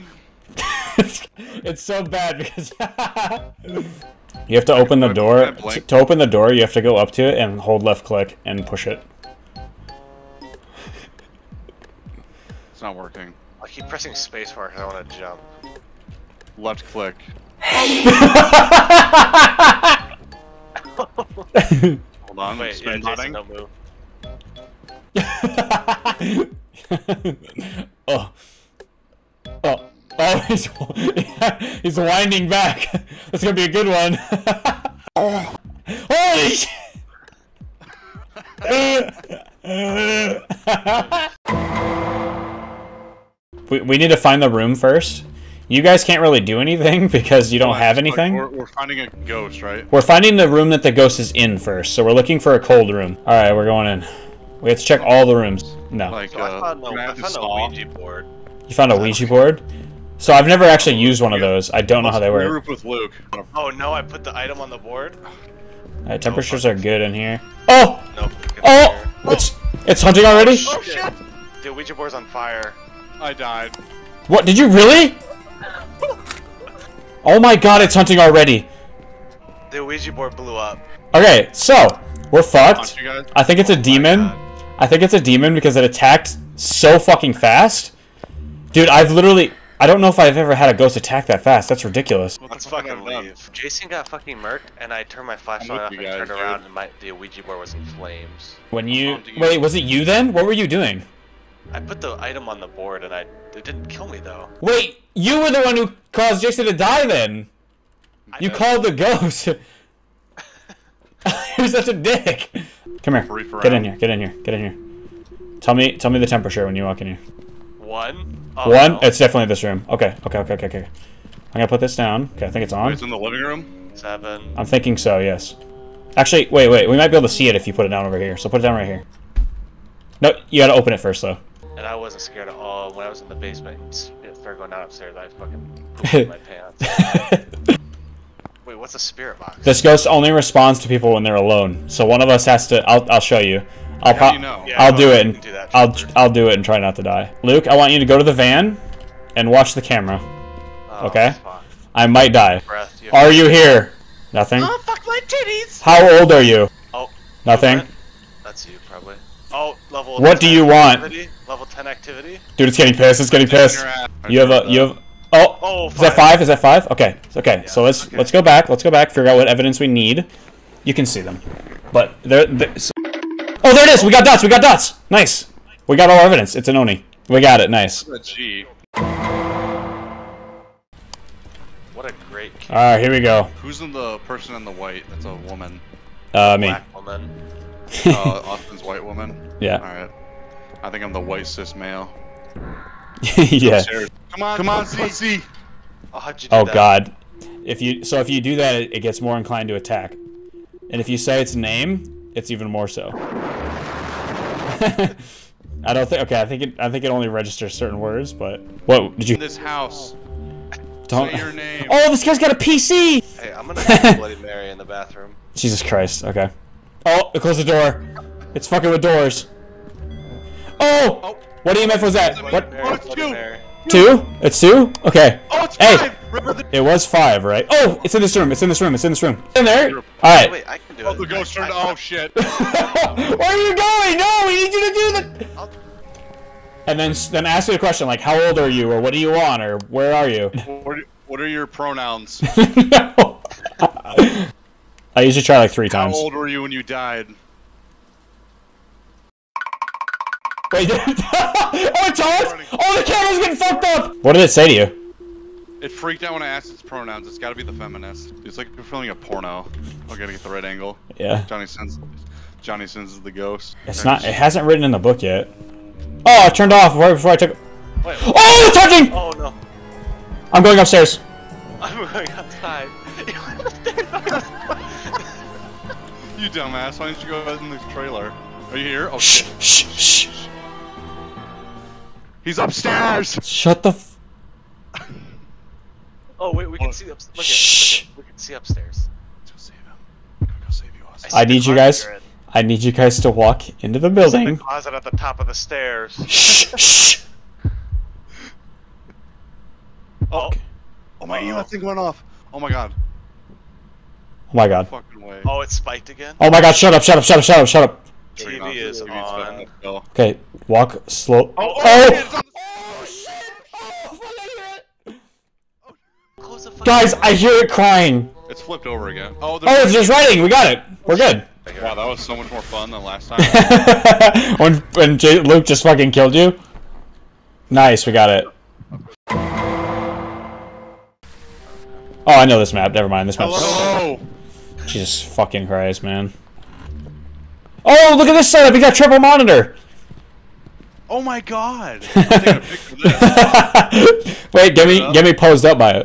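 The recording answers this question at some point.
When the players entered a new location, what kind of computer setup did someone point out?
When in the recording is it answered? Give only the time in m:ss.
5:38.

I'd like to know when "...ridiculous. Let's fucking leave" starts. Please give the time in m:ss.
1:31.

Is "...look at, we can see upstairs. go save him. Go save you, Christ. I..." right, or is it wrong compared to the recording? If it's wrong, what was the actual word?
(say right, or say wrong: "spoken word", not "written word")
wrong: "Austin", not "Christ".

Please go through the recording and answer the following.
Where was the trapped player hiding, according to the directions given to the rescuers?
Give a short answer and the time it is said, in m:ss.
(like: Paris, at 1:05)
The closet at the top of the stairs, at 4:54.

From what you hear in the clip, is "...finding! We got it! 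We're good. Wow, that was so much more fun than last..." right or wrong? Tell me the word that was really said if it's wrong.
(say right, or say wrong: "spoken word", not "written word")
wrong: "writing", not "finding".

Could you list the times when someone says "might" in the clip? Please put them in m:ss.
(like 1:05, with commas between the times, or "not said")
2:06, 2:32.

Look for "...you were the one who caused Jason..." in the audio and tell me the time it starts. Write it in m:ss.
1:45.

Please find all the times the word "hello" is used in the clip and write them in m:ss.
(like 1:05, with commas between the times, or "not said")
not said.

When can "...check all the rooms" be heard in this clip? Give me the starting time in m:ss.
0:54.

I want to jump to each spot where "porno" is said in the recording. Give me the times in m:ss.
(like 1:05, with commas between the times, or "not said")
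4:19.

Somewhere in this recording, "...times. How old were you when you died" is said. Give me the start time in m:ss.
4:05.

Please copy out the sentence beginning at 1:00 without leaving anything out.
So I've never actually used one of those.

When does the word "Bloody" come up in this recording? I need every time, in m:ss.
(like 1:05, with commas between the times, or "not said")
3:34.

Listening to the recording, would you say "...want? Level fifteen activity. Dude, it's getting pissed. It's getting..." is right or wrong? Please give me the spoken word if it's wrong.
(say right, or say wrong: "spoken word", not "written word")
wrong: "ten", not "fifteen".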